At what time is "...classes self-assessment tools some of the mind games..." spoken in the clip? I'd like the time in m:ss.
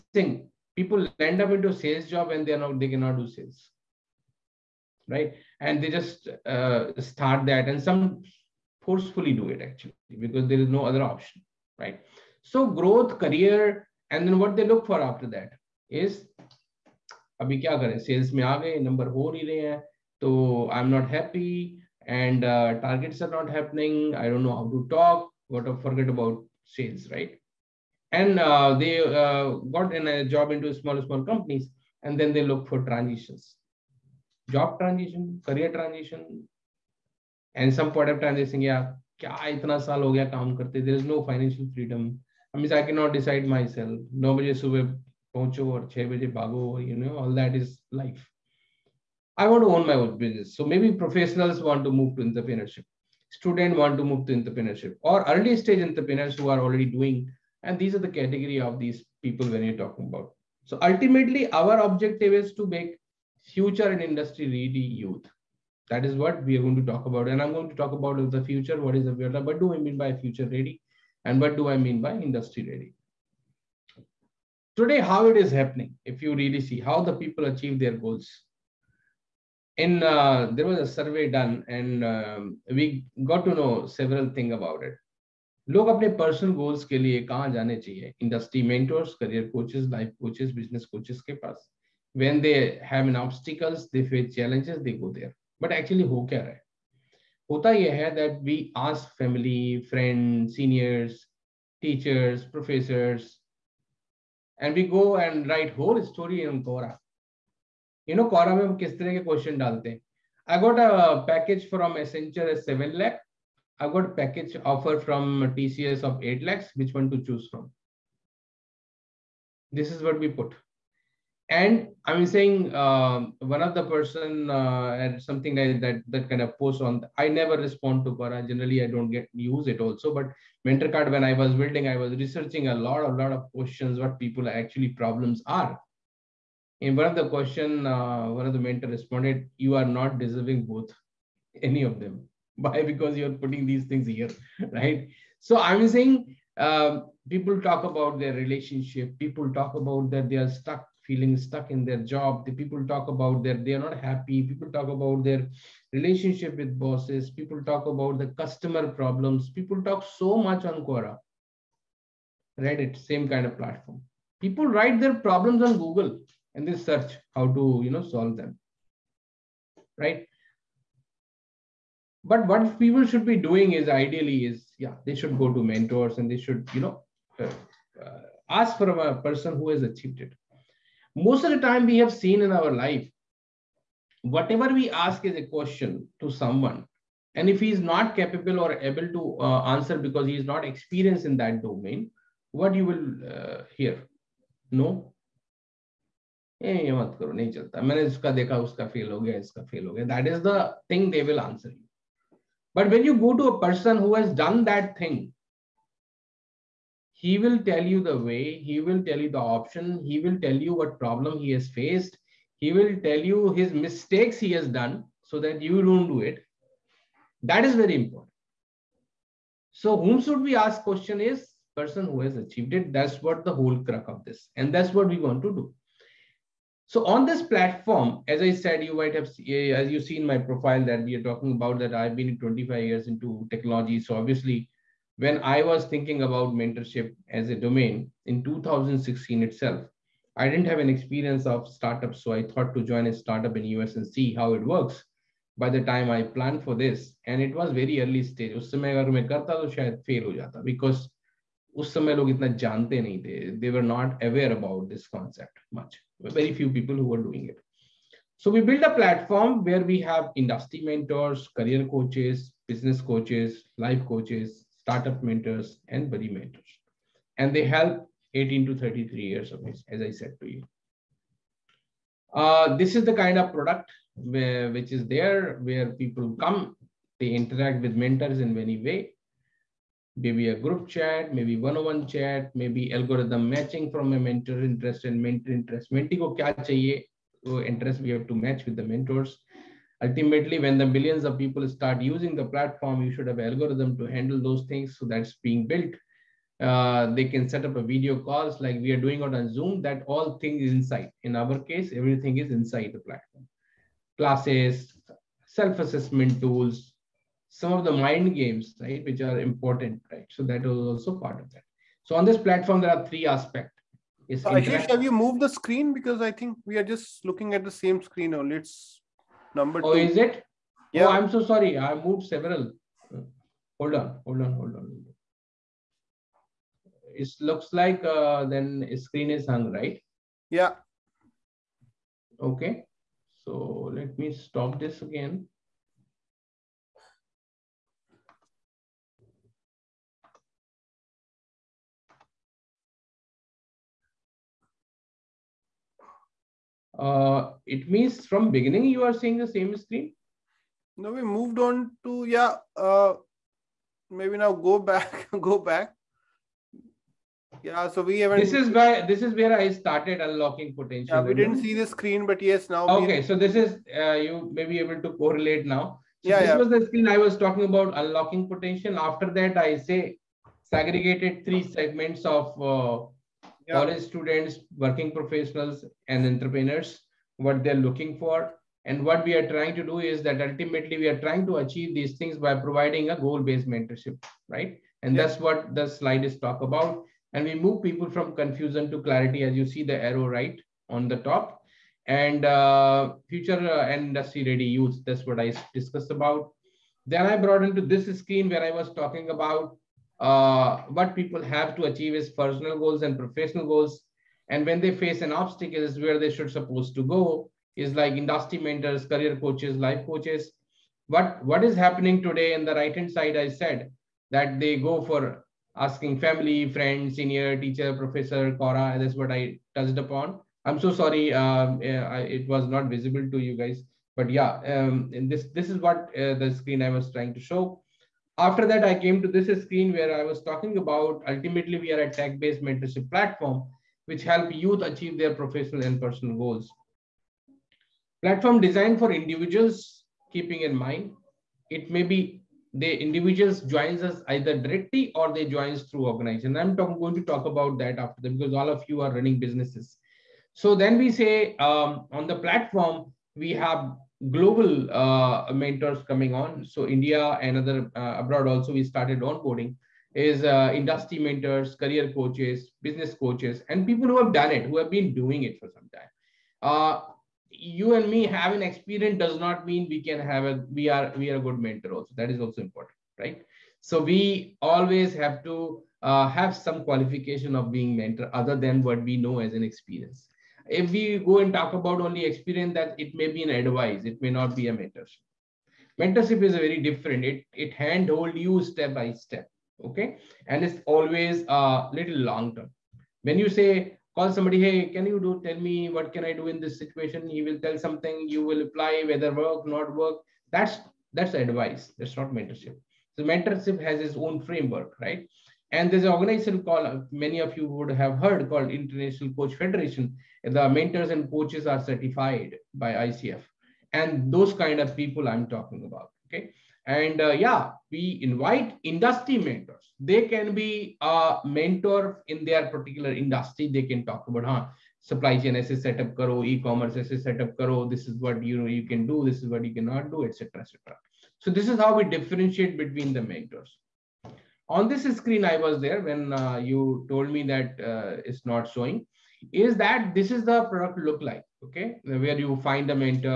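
5:04.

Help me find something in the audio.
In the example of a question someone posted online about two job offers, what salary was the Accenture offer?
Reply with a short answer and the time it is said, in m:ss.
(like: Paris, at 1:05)
7 lakh, at 1:52.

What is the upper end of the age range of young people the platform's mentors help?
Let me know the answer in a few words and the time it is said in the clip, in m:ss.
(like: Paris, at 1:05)
33, at 4:28.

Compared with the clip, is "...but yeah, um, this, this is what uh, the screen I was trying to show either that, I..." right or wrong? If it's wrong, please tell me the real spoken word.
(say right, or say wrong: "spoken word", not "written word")
wrong: "after", not "either".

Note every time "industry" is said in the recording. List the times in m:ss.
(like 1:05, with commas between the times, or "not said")
1:04, 1:12, 4:20, 6:33, 6:48, 7:40, 8:38, 8:43.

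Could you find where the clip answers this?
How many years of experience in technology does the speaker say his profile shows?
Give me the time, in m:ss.
3:52.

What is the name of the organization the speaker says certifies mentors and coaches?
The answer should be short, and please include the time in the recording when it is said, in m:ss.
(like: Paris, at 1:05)
International Coach Federation, at 8:28.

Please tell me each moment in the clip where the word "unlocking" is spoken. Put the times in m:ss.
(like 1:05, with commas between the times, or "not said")
6:00, 6:07.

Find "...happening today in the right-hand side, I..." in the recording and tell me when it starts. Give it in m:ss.
6:51.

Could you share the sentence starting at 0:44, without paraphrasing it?
नौ बजे सुबह पहुंचो you know all that is life.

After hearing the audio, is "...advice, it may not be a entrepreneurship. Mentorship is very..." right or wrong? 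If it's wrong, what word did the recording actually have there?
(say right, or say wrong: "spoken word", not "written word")
wrong: "mentorship", not "entrepreneurship".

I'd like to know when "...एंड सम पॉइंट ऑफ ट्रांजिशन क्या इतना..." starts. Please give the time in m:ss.
0:37.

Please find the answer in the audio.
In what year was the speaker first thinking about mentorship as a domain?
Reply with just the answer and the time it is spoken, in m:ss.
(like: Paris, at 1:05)
2016, at 3:58.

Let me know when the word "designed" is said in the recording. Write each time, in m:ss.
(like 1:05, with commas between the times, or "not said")
7:18.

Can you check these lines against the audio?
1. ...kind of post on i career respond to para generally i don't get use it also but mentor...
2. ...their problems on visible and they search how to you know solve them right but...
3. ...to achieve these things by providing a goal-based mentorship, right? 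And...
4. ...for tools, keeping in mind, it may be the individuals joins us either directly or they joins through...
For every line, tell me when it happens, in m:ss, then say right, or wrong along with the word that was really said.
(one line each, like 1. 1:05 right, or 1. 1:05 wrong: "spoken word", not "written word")
1. 2:06 wrong: "never", not "career"
2. 2:45 wrong: "google", not "visible"
3. 6:21 right
4. 7:18 wrong: "individuals", not "tools".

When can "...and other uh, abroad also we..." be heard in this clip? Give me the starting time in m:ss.
7:37.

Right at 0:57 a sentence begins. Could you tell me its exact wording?
And these are the category of these people when you're talking about.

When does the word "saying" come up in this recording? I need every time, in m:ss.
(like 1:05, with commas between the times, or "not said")
0:00, 2:02, 2:25.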